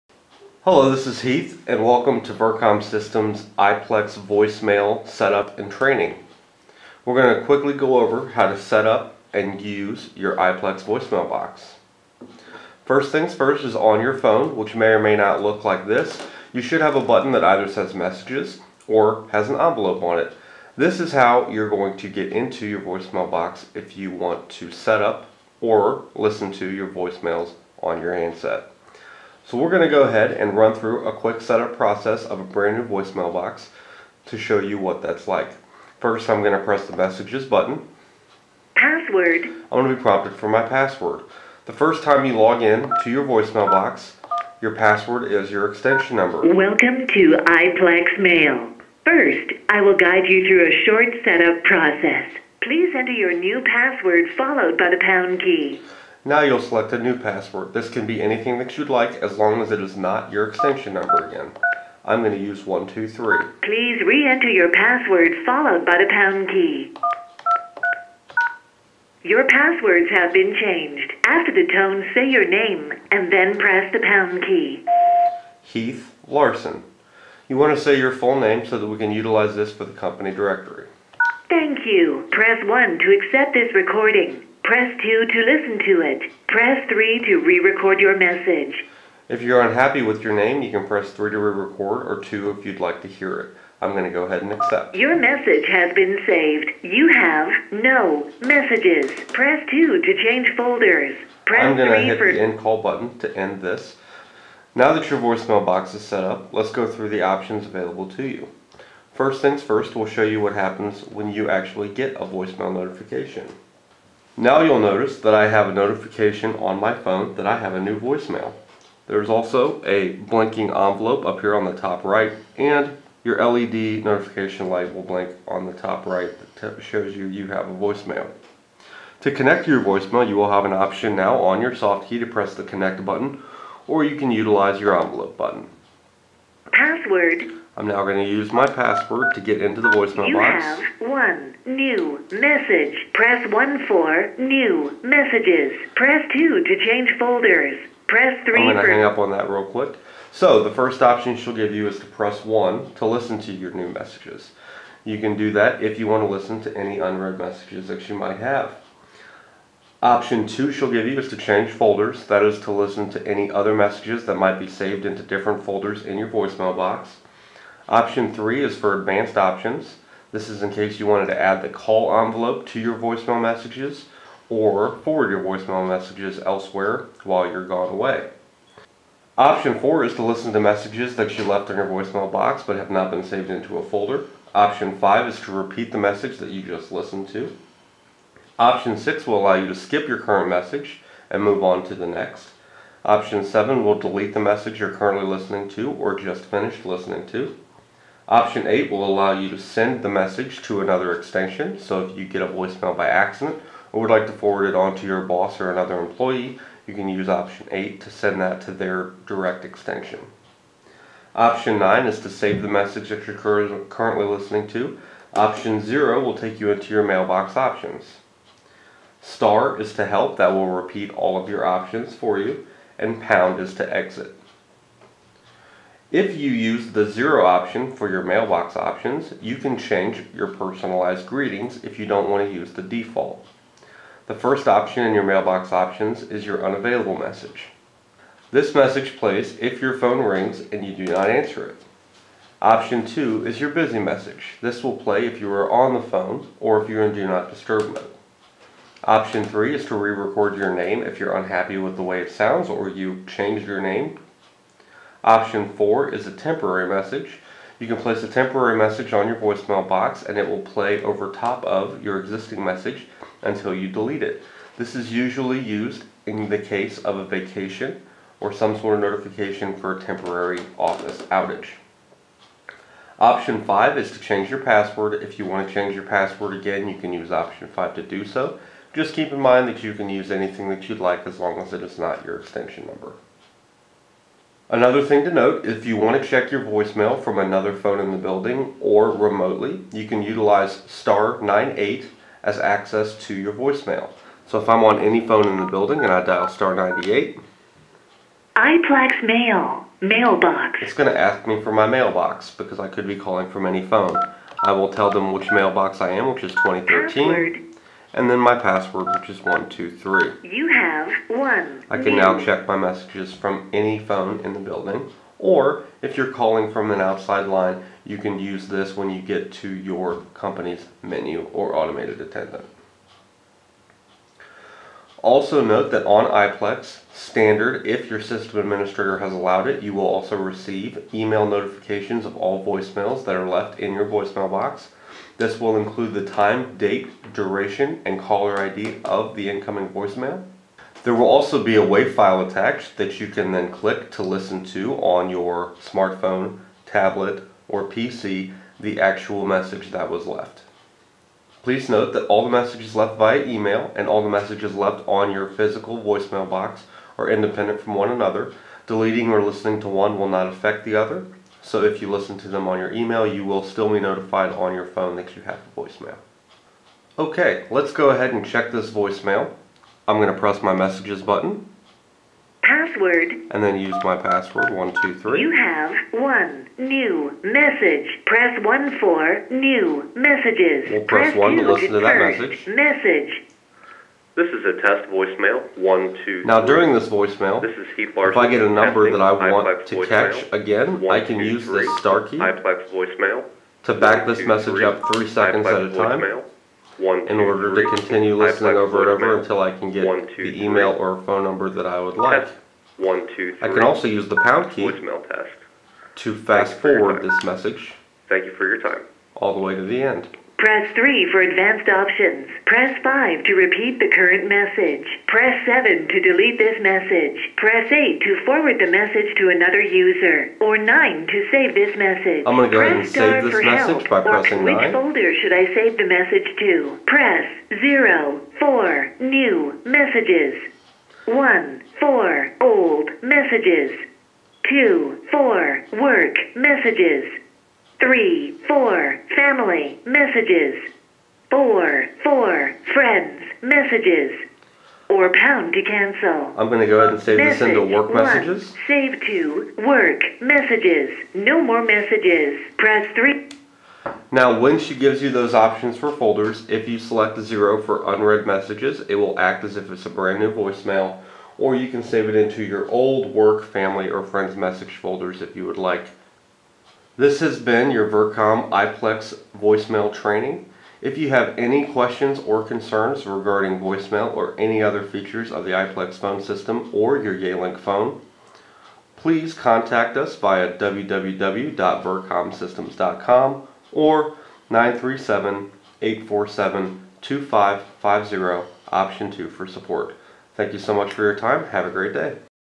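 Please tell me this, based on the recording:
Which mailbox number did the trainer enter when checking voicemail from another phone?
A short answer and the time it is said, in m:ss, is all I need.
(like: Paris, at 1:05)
2013, at 5:06.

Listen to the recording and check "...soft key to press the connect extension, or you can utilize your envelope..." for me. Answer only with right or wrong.
wrong.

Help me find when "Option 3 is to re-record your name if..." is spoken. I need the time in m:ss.
4:09.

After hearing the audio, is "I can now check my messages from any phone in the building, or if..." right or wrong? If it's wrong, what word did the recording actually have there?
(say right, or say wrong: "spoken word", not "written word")
right.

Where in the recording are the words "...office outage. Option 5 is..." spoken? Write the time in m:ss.
4:30.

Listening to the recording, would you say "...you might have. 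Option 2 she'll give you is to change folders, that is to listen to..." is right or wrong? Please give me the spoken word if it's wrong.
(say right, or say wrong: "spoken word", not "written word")
right.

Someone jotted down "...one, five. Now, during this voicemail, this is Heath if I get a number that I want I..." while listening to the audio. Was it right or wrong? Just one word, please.
wrong.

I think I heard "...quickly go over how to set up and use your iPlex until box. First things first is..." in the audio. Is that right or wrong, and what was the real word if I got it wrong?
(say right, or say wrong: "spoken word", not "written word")
wrong: "voicemail", not "until".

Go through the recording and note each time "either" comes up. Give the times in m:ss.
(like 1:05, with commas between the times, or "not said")
0:17.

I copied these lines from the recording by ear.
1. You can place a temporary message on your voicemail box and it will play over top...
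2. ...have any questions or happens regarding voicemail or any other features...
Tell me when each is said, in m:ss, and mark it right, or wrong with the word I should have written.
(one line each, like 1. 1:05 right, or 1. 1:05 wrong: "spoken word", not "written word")
1. 4:17 right
2. 7:51 wrong: "concerns", not "happens".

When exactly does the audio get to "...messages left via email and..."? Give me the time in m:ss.
5:52.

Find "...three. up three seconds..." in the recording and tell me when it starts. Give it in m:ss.
6:34.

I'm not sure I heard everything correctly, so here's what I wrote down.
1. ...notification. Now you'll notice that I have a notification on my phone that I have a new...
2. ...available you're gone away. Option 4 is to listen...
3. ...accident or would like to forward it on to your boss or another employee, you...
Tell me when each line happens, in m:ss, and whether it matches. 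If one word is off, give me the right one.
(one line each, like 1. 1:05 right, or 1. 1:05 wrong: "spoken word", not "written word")
1. 1:52 right
2. 2:57 wrong: "while", not "available"
3. 3:23 right.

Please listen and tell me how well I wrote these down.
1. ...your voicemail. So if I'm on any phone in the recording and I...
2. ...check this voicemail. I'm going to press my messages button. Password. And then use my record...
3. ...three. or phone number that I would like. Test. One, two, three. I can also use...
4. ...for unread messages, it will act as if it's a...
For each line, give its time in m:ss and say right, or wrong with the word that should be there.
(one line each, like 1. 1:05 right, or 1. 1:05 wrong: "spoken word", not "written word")
1. 4:53 wrong: "building", not "recording"
2. 6:08 wrong: "password", not "record"
3. 6:40 right
4. 7:37 right.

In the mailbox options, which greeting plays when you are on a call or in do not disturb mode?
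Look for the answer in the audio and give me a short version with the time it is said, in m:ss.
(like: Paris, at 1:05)
Busy message, at 4:03.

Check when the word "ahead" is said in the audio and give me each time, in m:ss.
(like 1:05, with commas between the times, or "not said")
0:30, 1:34, 6:08, 7:02, 7:27.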